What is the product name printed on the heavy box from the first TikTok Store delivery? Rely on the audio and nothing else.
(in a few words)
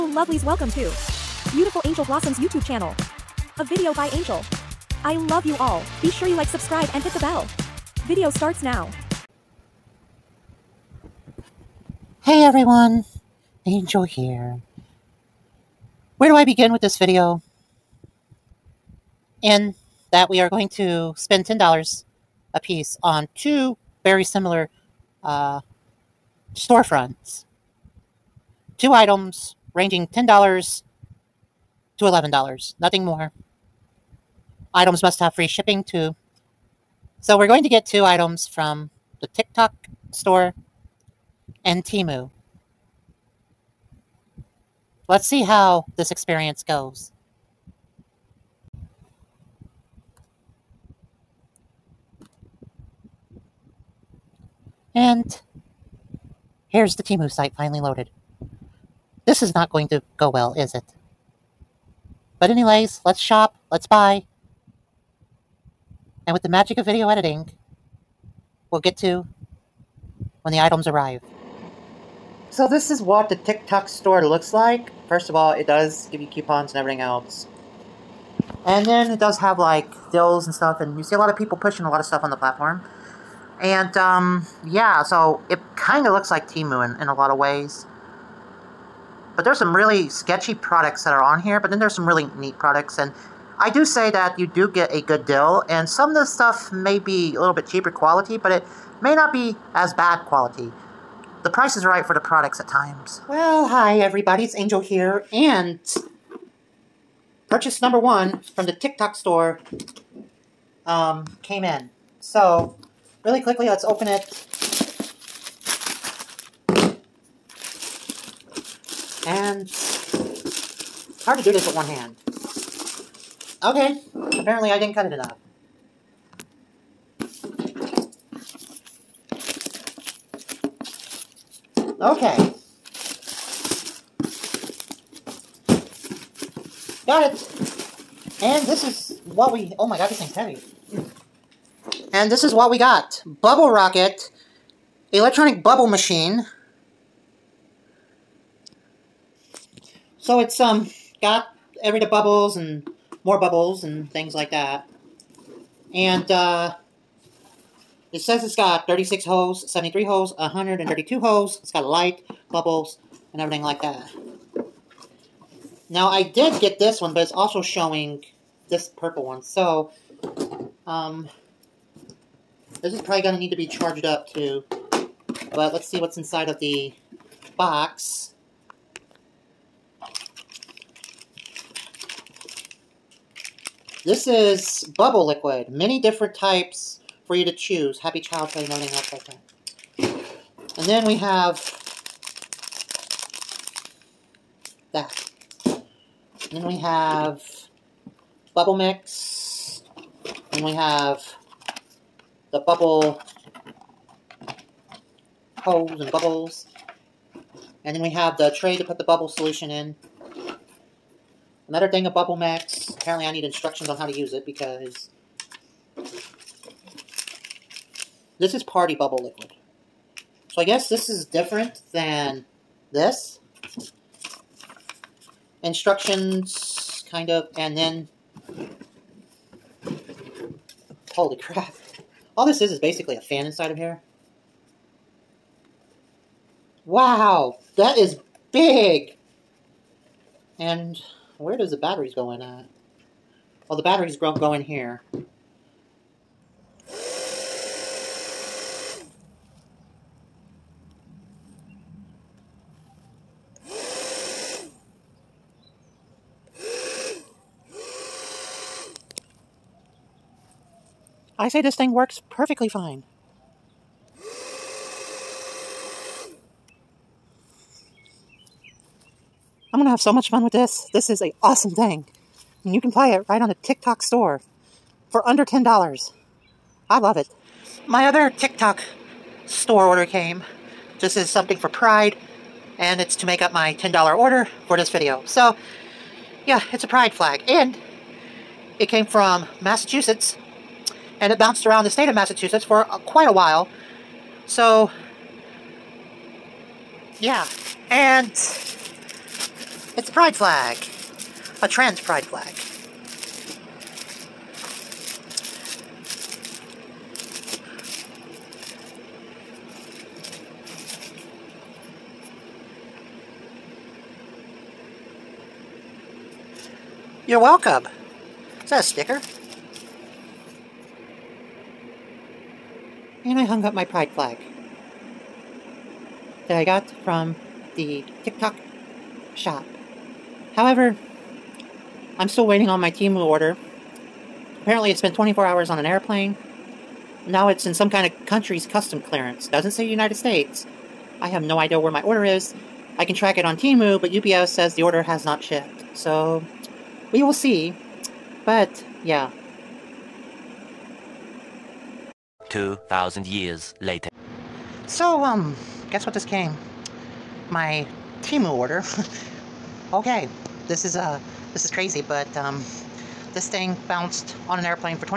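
Bubble Rocket.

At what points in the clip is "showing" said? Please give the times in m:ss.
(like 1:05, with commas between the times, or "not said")
2:47.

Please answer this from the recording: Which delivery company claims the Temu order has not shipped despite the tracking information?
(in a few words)
UPS.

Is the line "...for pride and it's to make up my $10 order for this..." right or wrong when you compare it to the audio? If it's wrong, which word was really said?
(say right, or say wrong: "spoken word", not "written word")
right.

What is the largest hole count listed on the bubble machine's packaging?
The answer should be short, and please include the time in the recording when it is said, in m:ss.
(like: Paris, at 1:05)
132, at 2:40.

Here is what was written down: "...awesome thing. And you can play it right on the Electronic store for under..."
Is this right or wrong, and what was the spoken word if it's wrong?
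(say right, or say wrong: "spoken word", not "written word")
wrong: "TikTok", not "Electronic".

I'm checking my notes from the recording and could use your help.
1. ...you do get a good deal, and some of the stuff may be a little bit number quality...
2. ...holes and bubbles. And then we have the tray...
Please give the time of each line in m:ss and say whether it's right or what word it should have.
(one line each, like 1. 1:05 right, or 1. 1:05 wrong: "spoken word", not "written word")
1. 1:34 wrong: "cheaper", not "number"
2. 3:25 right.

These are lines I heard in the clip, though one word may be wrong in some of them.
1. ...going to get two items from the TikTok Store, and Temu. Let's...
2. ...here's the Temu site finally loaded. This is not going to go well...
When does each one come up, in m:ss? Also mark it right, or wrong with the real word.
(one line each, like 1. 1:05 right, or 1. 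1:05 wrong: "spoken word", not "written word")
1. 0:37 right
2. 0:56 right.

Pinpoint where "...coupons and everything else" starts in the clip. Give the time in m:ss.
1:16.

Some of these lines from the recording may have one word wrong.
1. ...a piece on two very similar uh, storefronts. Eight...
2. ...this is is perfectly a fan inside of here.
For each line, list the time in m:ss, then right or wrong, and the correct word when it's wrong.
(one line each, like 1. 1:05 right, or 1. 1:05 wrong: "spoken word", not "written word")
1. 0:22 wrong: "Two", not "Eight"
2. 3:52 wrong: "basically", not "perfectly".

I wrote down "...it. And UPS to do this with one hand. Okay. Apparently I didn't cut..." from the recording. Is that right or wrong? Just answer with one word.
wrong.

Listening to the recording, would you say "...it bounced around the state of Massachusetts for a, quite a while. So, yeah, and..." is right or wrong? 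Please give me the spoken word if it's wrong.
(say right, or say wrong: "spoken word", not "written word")
right.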